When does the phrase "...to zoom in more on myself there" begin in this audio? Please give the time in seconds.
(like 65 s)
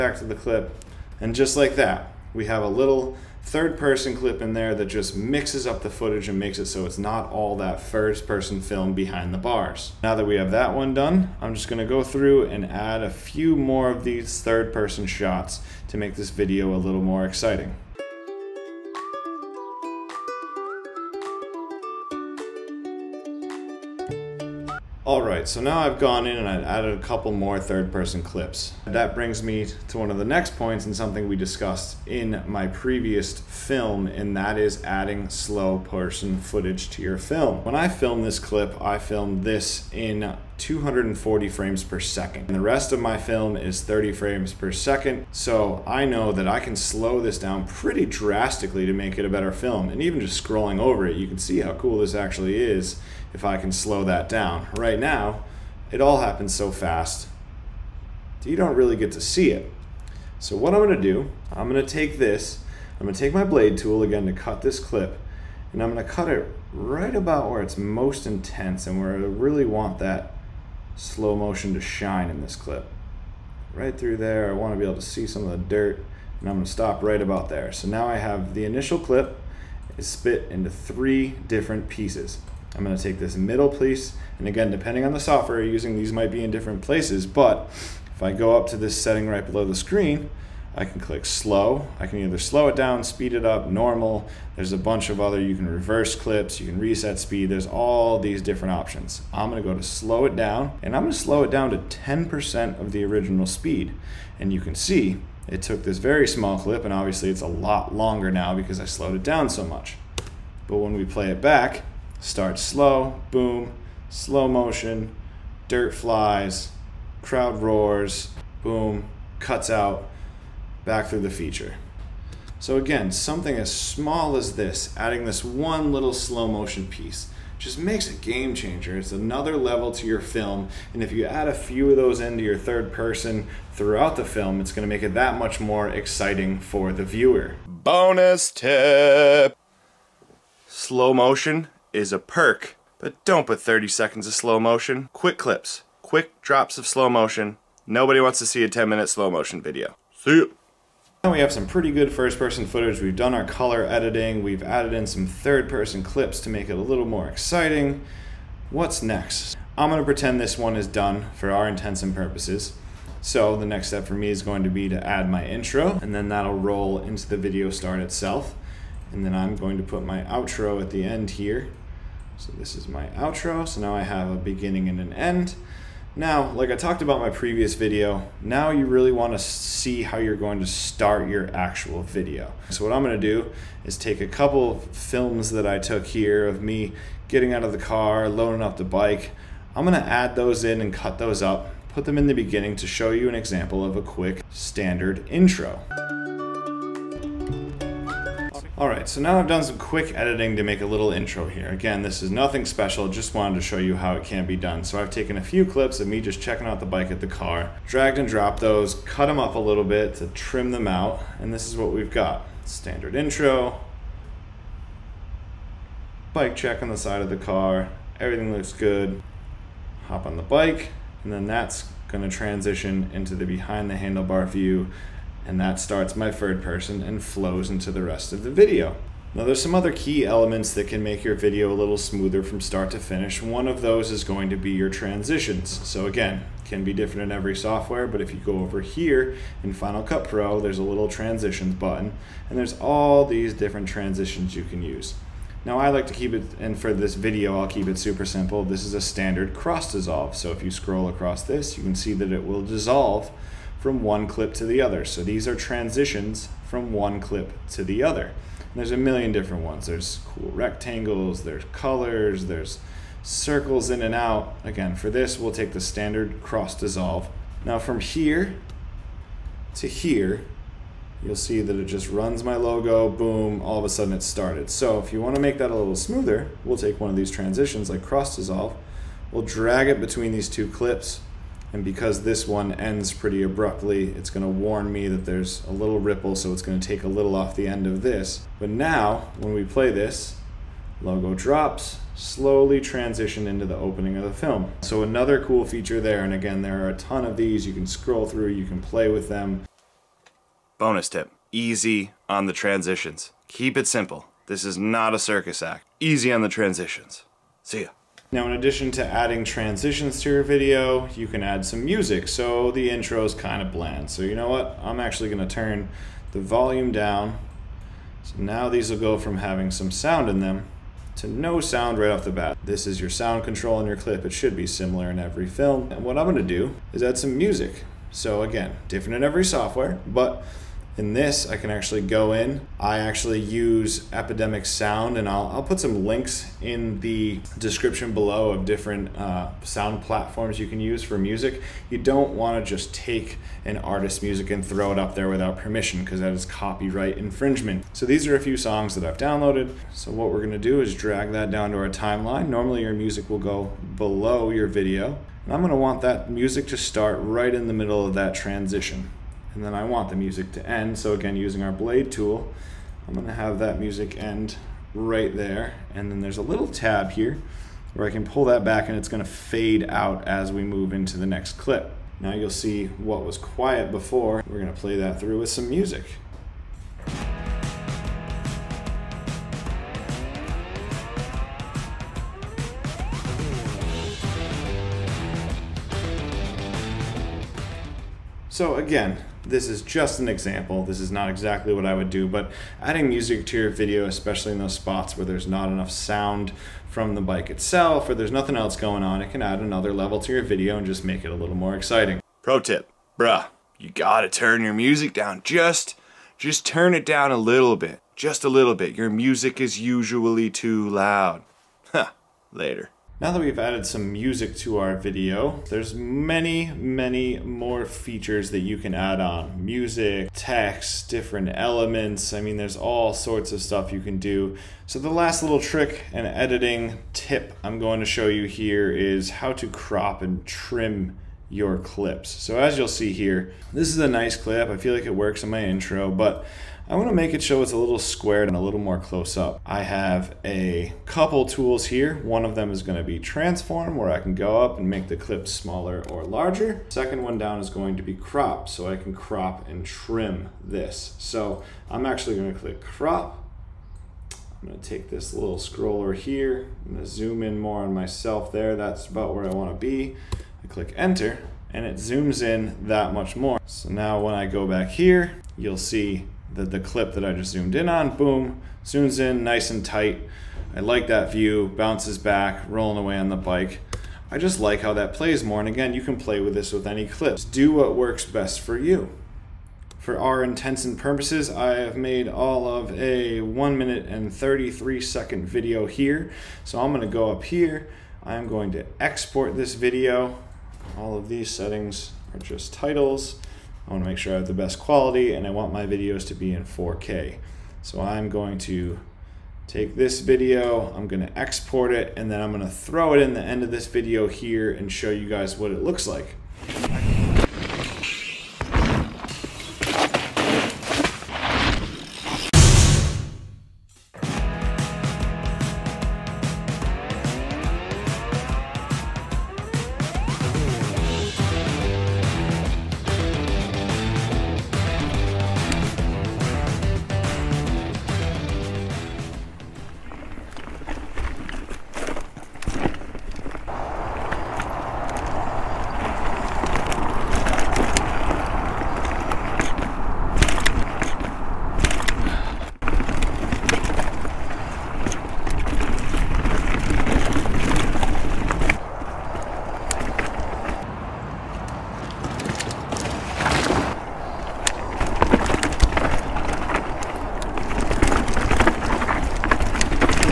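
457 s.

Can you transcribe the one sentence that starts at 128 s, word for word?
It's another level to your film.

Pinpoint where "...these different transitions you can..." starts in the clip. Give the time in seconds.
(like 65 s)
243 s.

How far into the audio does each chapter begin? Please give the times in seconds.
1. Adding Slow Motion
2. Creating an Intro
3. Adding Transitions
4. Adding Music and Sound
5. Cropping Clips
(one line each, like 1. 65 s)
1. 34 s
2. 178 s
3. 233 s
4. 310 s
5. 428 s.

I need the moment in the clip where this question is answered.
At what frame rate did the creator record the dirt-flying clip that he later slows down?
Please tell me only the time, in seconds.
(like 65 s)
40 s.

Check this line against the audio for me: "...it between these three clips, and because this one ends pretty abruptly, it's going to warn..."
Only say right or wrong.
wrong.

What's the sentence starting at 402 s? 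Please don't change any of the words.
Pro tip, bruh, you gotta turn your music down.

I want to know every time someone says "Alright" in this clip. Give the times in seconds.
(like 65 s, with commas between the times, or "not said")
198 s.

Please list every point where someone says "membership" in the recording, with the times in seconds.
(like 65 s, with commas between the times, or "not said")
not said.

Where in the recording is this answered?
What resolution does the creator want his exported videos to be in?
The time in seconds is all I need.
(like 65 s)
496 s.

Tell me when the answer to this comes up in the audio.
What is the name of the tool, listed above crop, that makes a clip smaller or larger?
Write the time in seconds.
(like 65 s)
443 s.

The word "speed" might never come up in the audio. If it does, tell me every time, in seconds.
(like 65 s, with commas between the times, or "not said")
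93 s, 97 s, 103 s.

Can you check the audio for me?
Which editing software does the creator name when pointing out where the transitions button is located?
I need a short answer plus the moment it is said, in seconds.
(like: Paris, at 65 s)
Final Cut Pro, at 239 s.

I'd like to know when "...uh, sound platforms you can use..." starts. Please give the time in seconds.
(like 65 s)
339 s.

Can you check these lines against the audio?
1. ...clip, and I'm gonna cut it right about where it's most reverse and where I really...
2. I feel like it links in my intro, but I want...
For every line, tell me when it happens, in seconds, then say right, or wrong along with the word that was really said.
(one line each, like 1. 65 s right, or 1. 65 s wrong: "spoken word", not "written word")
1. 64 s wrong: "intense", not "reverse"
2. 434 s wrong: "works", not "links".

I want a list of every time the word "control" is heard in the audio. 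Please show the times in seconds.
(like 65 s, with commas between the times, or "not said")
323 s.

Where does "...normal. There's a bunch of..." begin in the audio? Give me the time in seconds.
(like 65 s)
93 s.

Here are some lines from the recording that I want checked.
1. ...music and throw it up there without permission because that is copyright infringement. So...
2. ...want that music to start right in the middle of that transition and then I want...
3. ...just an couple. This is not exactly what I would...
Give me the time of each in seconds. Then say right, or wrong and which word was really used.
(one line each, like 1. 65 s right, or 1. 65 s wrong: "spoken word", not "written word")
1. 344 s right
2. 355 s right
3. 389 s wrong: "example", not "couple".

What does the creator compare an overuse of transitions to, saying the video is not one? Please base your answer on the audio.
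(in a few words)
A circus act.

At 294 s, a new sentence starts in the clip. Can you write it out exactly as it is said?
So another cool feature there, and again, there are a ton of these.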